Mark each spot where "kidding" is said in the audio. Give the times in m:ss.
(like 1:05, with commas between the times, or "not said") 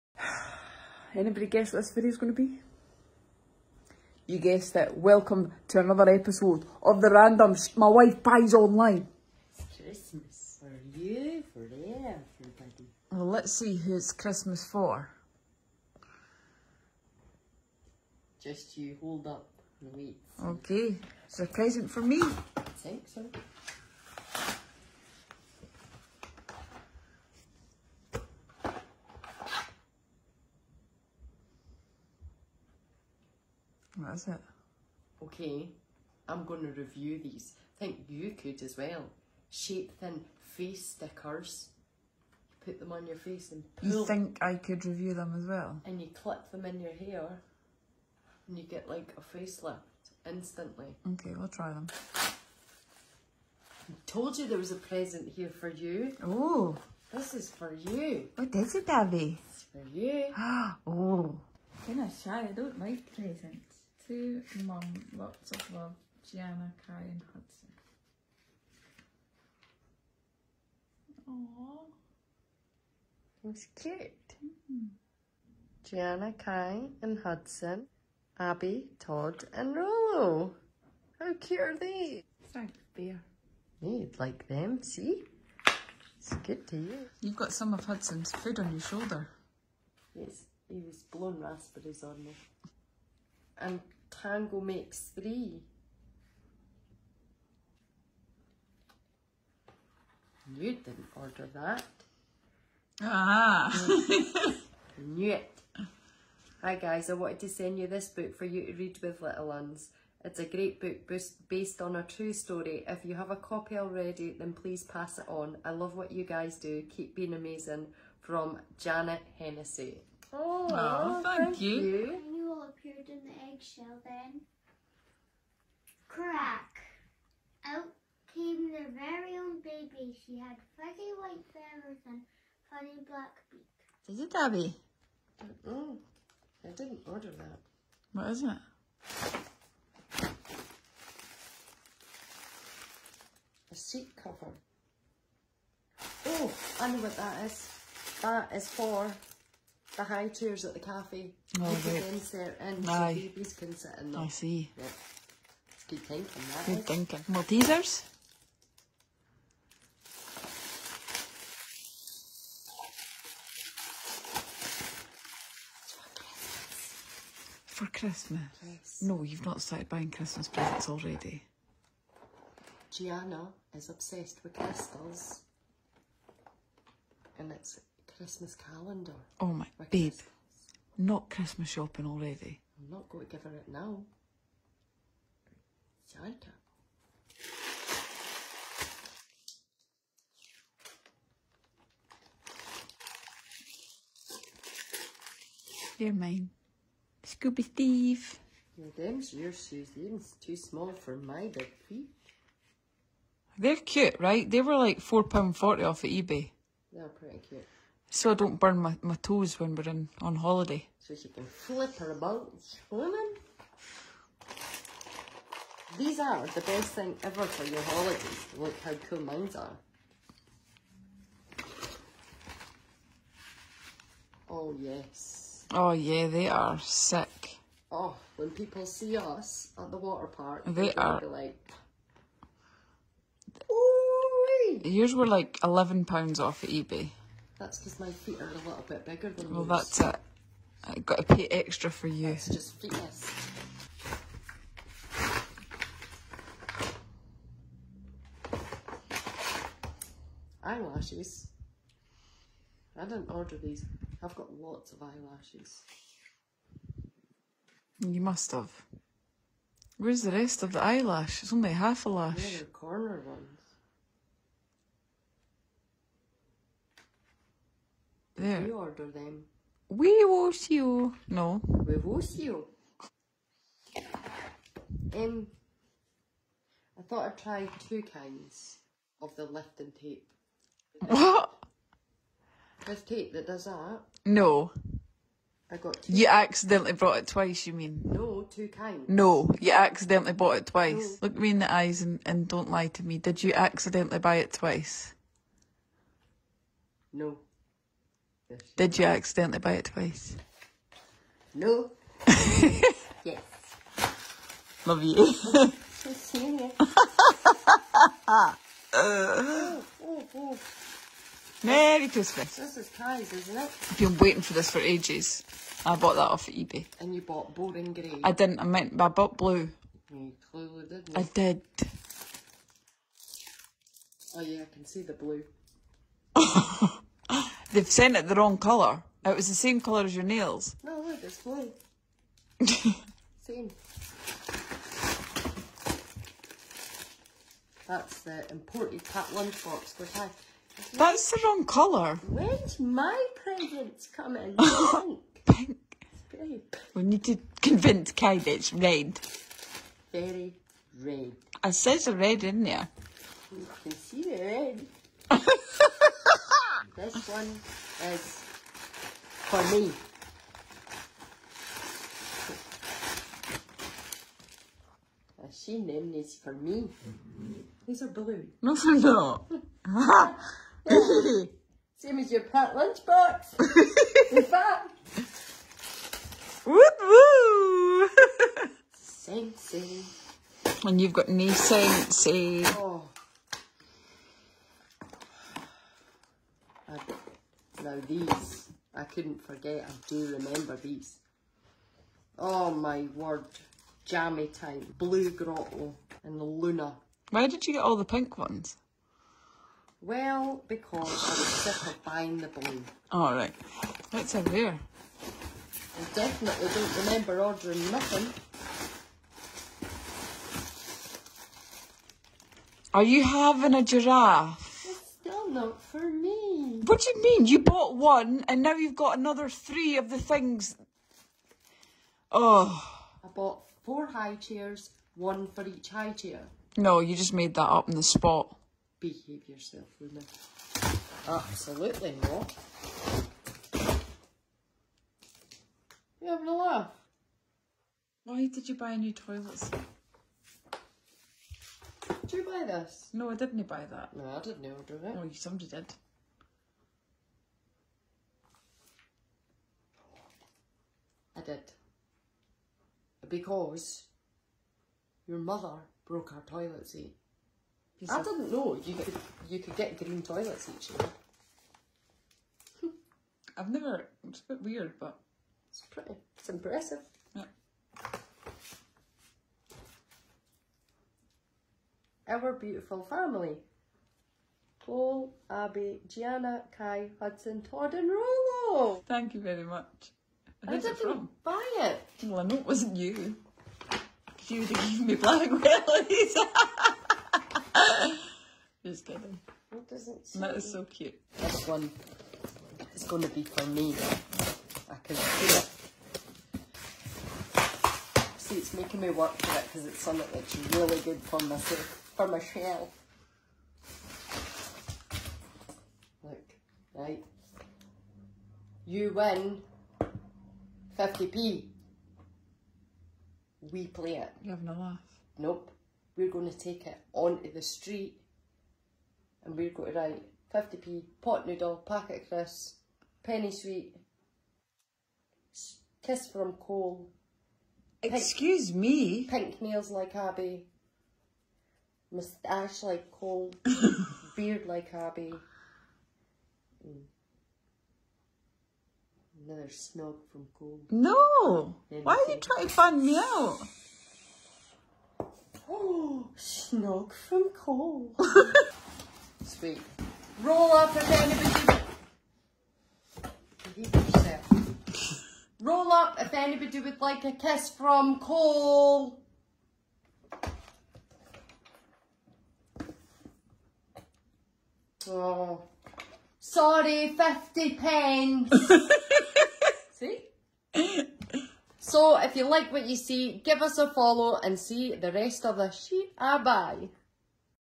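8:09.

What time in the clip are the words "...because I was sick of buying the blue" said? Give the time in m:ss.
6:40.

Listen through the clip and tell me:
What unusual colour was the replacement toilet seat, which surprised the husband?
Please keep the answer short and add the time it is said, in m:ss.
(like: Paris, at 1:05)
green, at 7:39.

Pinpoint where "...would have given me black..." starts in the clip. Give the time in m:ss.
8:04.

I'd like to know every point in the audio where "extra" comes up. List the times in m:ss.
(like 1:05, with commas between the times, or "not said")
4:01.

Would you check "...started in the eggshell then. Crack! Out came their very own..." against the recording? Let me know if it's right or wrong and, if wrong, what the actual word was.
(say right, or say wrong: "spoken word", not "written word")
wrong: "appeared", not "started".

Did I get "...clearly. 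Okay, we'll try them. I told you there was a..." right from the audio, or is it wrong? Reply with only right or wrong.
wrong.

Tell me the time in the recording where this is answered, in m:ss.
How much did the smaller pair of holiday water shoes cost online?
3:24.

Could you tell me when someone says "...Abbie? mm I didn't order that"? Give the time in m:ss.
2:14.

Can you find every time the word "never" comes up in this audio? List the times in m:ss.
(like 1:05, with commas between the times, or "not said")
7:43.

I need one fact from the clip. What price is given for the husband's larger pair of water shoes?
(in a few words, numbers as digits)
£11.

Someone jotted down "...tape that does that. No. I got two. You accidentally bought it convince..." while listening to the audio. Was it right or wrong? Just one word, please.
wrong.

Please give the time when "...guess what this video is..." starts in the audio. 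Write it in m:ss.
0:01.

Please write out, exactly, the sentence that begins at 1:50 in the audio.
It's a great book based on a true story.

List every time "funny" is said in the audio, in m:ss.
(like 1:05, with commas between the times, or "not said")
2:12.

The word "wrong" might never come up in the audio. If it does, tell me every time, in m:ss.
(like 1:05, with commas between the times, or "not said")
5:28, 5:41.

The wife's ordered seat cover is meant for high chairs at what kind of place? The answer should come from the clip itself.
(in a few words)
the cafe.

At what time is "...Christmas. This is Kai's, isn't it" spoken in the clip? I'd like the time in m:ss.
5:12.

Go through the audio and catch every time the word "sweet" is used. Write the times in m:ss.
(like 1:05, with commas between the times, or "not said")
8:43, 9:09.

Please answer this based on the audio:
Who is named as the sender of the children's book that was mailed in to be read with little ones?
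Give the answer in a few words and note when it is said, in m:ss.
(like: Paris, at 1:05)
Janet Hennessy, at 1:58.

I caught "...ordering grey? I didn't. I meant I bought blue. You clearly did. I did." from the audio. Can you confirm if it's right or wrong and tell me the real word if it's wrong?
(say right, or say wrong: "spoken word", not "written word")
wrong: "boring", not "ordering".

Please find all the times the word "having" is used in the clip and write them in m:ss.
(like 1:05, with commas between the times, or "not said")
6:53, 7:16, 8:34.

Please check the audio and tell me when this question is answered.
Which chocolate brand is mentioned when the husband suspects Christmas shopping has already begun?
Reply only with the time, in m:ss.
2:37.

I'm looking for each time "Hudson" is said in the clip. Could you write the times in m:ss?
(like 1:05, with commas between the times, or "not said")
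1:07, 1:17, 1:27, 7:57.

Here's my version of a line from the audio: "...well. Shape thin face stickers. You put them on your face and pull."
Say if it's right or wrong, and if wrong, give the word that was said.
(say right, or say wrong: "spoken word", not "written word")
right.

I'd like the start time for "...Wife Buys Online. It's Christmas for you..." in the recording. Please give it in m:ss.
0:07.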